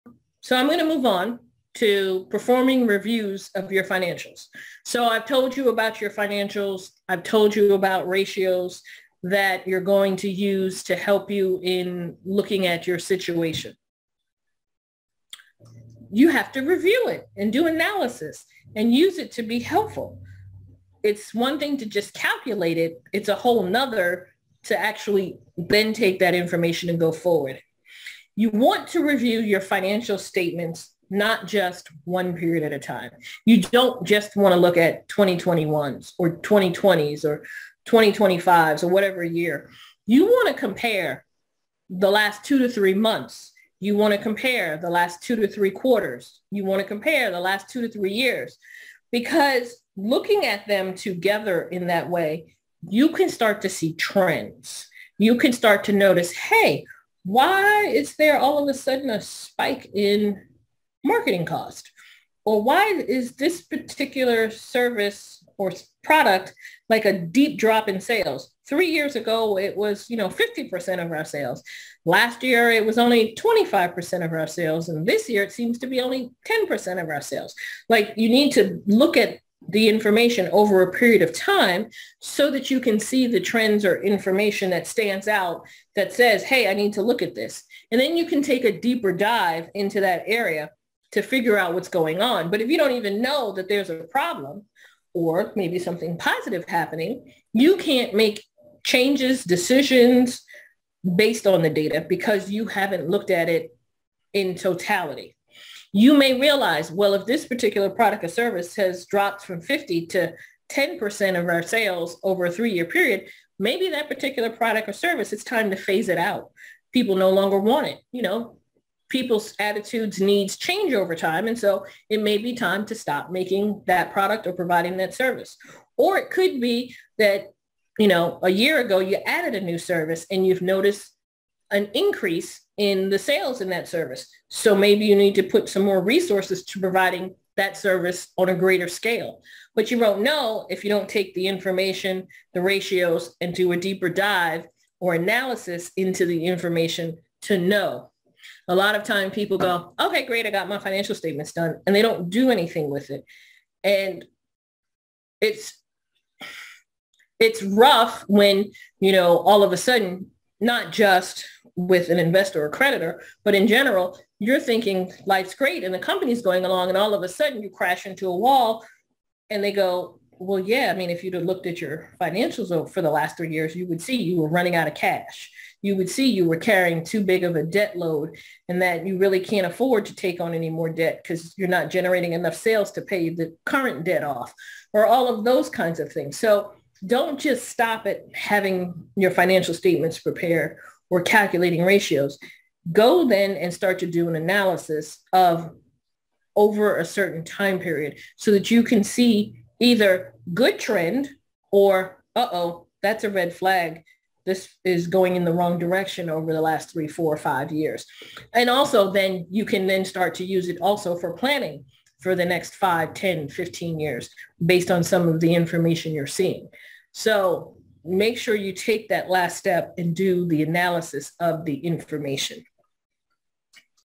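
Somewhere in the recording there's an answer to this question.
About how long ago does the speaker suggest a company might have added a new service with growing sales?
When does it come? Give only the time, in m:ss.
2:08.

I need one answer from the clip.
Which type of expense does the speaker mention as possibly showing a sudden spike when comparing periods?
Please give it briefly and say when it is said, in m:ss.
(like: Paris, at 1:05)
Marketing cost, at 1:01.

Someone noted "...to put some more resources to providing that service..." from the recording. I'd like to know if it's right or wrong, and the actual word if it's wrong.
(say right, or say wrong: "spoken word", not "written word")
right.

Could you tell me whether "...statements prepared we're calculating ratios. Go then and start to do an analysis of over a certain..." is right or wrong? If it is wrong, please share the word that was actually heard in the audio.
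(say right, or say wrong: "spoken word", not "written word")
right.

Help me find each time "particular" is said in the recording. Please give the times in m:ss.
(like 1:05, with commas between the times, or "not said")
1:03, 1:47, 1:54.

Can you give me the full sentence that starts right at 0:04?
So I've told you about your financials.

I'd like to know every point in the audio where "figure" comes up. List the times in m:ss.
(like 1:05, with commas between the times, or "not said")
1:31.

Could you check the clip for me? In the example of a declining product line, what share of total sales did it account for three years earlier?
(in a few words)
50%.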